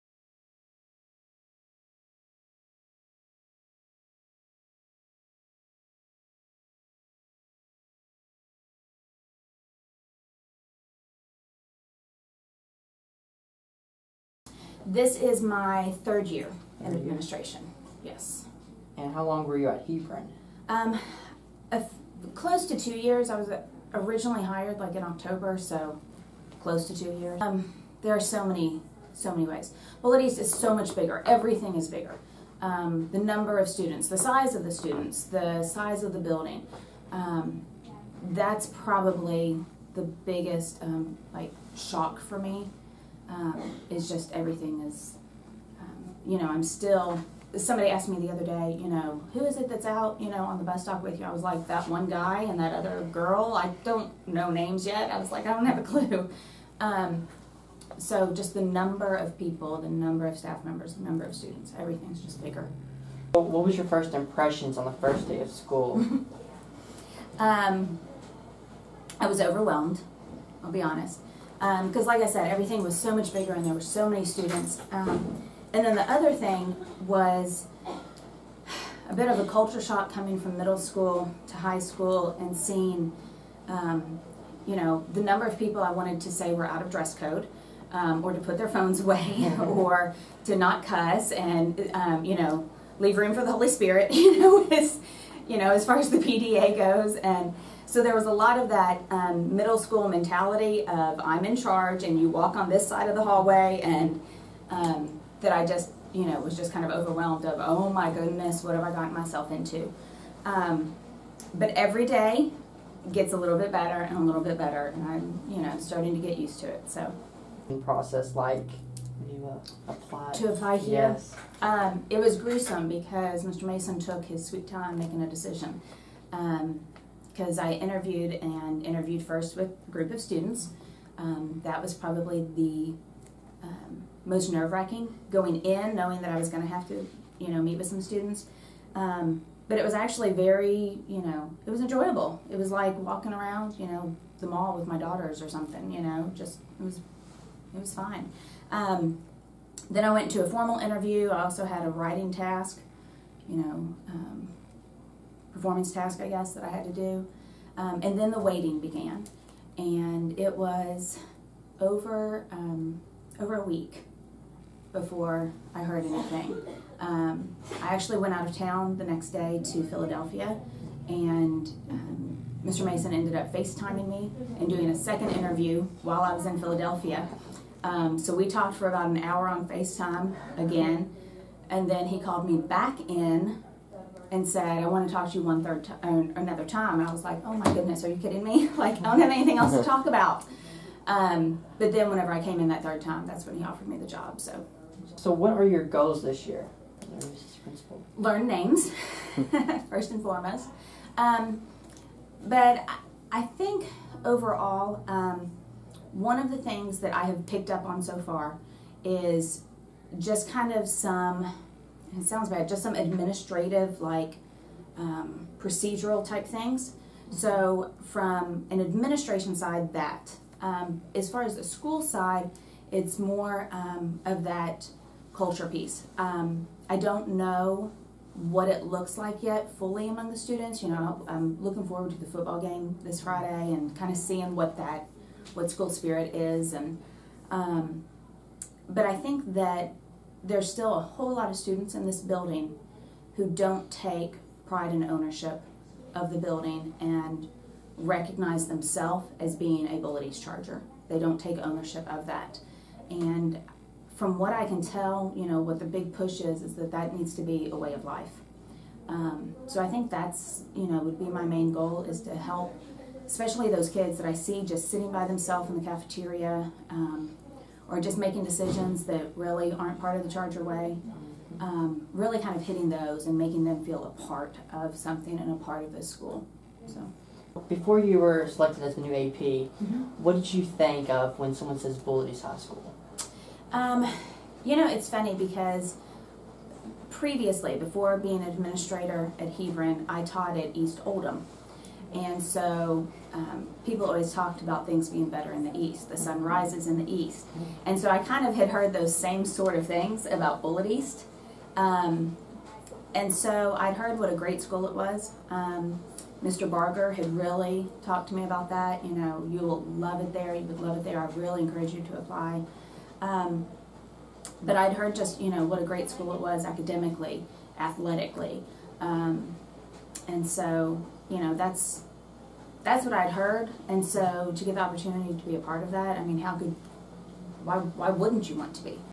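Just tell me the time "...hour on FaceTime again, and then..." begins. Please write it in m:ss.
2:59.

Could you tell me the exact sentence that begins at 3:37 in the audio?
So, from an administration side, that.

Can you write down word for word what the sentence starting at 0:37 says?
Um, that's probably the biggest um, like shock for me um, is just everything is, um, you know, I'm still.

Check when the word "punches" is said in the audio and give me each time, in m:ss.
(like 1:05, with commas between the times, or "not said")
not said.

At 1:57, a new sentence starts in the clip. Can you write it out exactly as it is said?
Process like you uh, To apply here?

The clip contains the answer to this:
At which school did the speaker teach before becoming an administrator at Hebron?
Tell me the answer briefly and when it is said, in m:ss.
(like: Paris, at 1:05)
East Oldham, at 4:50.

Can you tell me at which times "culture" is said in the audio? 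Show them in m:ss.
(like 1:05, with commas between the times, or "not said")
1:19, 3:45.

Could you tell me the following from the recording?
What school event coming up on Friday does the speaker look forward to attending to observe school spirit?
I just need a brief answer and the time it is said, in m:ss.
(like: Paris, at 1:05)
football game, at 3:52.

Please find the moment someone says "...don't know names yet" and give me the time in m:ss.
0:53.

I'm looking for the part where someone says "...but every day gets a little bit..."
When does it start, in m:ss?
1:51.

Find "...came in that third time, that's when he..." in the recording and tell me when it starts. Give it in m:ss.
3:12.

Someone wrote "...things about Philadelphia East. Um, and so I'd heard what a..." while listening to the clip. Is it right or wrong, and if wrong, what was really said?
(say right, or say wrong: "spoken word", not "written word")
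wrong: "Bullitt", not "Philadelphia".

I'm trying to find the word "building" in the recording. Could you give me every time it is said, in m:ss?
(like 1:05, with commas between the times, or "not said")
0:36, 4:02, 4:06.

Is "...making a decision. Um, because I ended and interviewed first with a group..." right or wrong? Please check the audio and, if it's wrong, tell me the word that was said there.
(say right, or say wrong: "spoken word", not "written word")
wrong: "interviewed", not "ended".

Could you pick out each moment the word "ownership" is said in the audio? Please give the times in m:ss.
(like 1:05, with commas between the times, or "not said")
4:05, 4:11.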